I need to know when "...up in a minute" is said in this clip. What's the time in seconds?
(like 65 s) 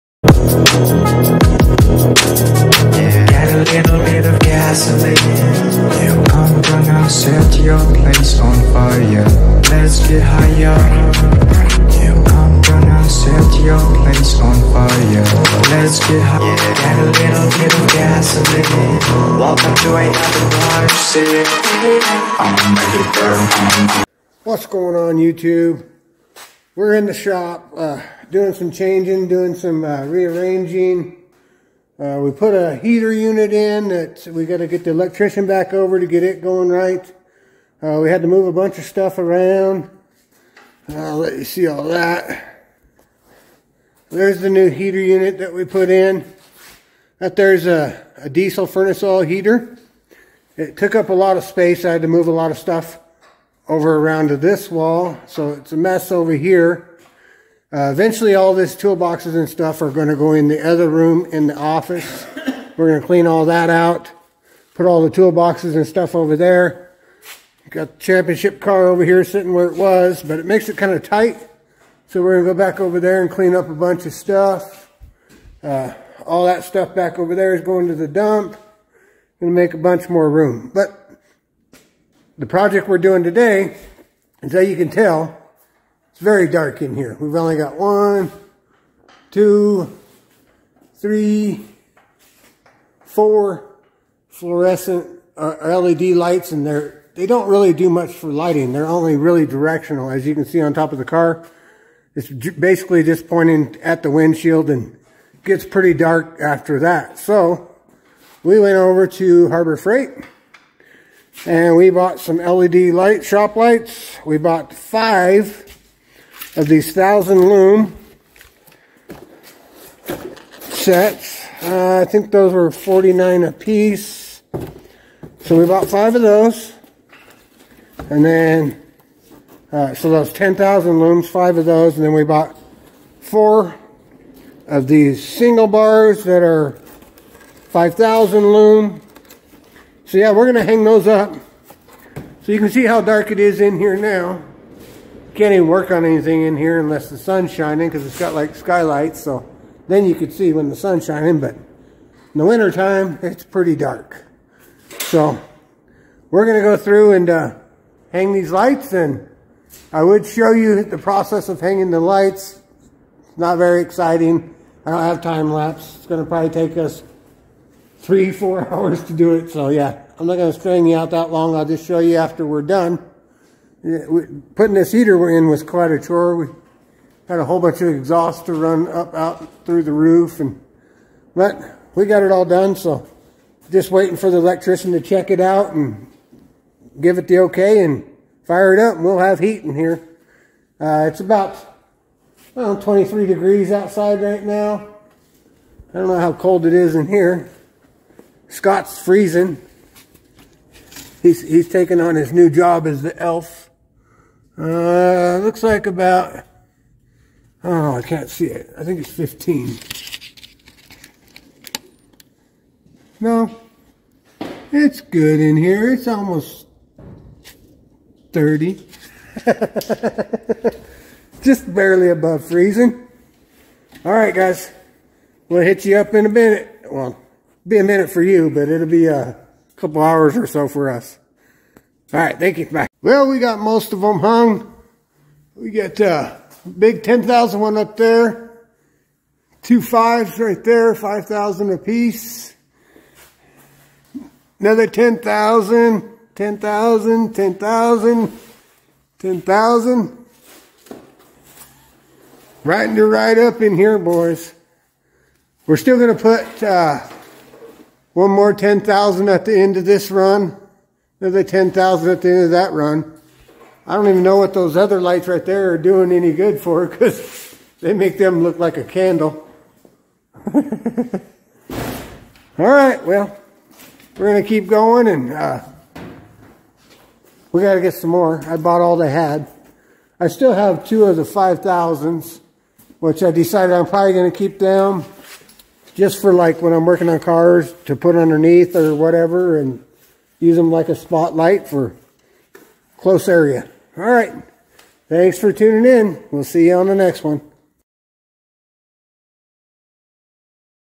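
225 s.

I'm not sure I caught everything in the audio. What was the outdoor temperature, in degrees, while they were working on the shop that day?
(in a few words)
23.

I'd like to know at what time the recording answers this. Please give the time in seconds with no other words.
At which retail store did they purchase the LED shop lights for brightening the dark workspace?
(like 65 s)
109 s.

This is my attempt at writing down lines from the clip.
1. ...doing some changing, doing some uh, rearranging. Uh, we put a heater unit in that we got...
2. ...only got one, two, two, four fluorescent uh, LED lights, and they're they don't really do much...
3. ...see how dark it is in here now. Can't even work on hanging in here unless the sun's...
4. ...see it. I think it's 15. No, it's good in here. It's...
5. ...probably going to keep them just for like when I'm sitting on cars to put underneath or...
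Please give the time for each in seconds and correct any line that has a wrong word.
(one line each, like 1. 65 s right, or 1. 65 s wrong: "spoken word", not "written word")
1. 28 s right
2. 87 s wrong: "three", not "two"
3. 142 s wrong: "anything", not "hanging"
4. 208 s right
5. 283 s wrong: "working", not "sitting".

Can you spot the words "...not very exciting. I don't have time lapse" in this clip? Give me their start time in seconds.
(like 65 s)
163 s.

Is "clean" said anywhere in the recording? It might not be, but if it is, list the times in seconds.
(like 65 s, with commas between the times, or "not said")
63 s, 73 s.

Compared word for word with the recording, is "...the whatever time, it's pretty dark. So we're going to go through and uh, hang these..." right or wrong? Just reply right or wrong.
wrong.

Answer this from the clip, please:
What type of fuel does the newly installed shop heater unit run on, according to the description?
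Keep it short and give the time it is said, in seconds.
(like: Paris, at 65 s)
Diesel furnace oil, at 48 s.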